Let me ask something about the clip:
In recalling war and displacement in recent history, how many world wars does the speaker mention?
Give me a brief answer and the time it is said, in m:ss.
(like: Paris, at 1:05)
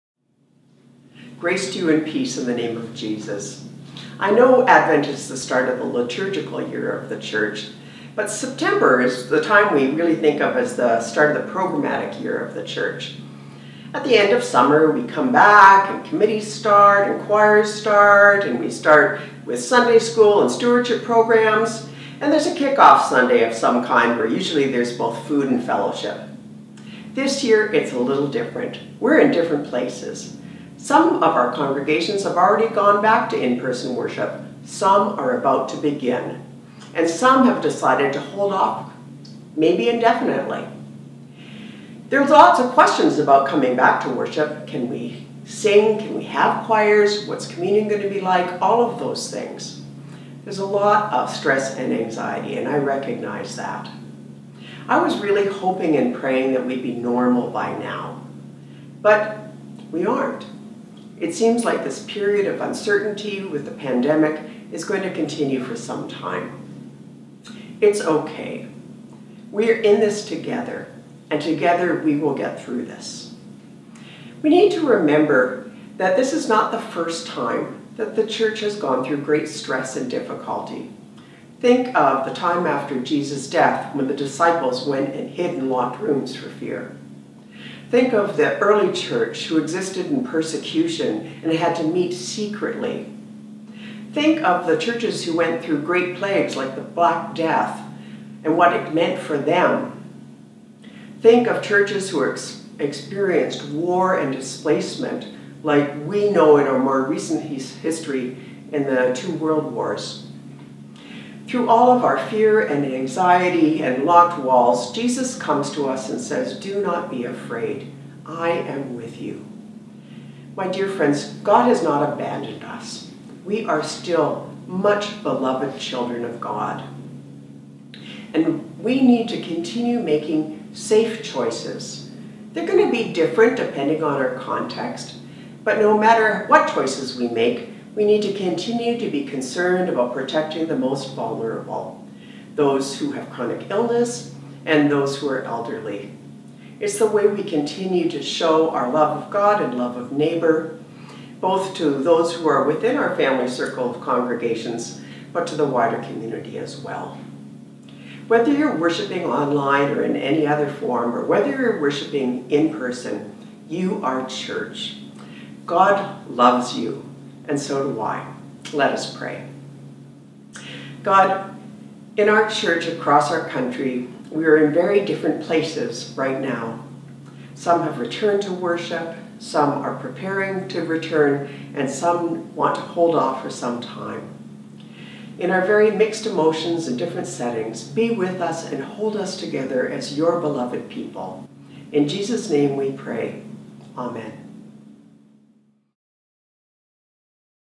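2, at 1:49.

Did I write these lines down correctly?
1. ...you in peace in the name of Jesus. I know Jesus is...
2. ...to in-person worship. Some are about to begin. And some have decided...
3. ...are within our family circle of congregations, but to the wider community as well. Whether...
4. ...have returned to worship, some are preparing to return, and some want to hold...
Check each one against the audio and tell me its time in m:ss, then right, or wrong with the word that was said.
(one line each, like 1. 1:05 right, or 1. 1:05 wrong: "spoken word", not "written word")
1. 0:01 wrong: "Advent", not "Jesus"
2. 0:33 right
3. 2:32 right
4. 2:57 right.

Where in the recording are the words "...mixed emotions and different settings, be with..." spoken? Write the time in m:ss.
3:05.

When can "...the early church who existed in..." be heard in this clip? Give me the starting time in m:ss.
1:28.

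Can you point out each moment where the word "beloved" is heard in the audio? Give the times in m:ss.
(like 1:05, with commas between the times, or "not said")
2:05, 3:10.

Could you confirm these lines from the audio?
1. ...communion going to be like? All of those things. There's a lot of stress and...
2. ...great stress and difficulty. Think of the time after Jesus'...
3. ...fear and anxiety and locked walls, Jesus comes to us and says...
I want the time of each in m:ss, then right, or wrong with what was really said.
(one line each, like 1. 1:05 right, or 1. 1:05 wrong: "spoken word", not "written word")
1. 0:47 right
2. 1:19 right
3. 1:52 right.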